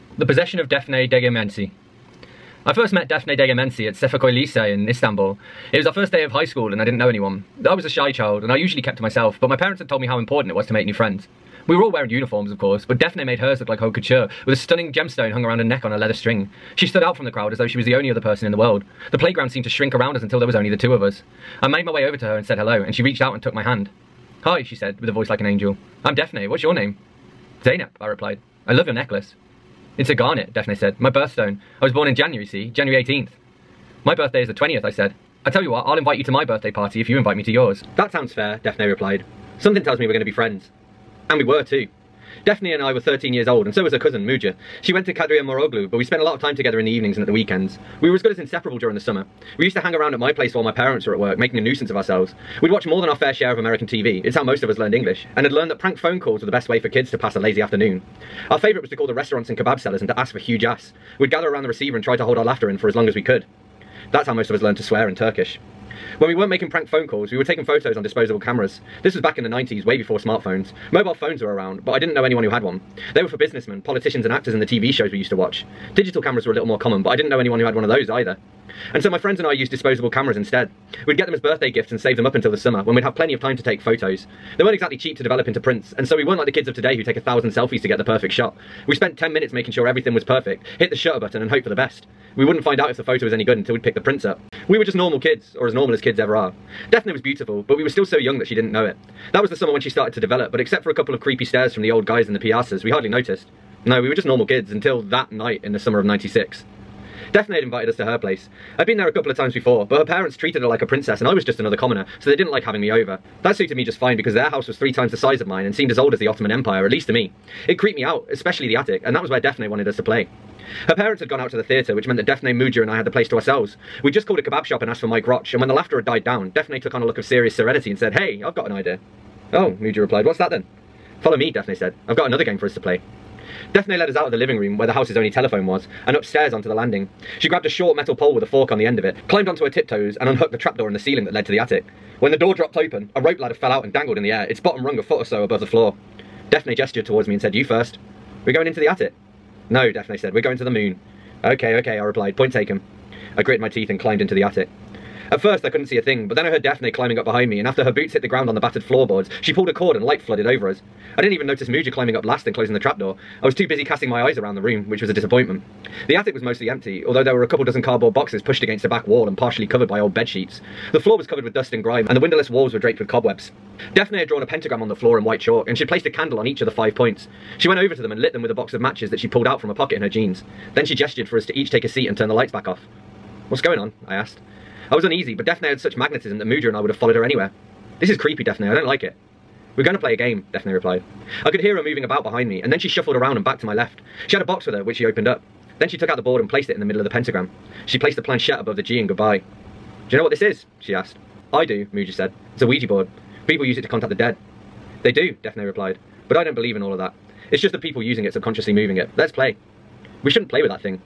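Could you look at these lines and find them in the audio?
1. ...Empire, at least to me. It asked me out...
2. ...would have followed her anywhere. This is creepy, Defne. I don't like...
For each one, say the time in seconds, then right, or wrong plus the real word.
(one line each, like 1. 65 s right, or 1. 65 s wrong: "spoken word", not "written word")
1. 116 s wrong: "creeped", not "asked"
2. 186 s right.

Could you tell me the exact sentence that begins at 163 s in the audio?
I was too busy casting my eyes around the room, which was a disappointment.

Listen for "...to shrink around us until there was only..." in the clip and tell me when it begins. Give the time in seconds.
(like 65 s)
19 s.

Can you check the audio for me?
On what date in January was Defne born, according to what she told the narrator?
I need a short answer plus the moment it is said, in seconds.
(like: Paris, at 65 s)
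January 18th, at 32 s.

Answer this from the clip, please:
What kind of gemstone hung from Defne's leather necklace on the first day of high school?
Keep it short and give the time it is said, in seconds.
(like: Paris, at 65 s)
Garnet, at 30 s.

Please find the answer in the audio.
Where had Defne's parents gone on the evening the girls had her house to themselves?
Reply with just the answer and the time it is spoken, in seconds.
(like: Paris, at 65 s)
The theatre, at 121 s.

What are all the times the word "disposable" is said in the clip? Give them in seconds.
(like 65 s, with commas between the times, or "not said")
68 s, 79 s.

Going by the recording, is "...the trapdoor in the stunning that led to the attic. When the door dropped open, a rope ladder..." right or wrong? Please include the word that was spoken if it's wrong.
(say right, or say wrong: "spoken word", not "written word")
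wrong: "ceiling", not "stunning".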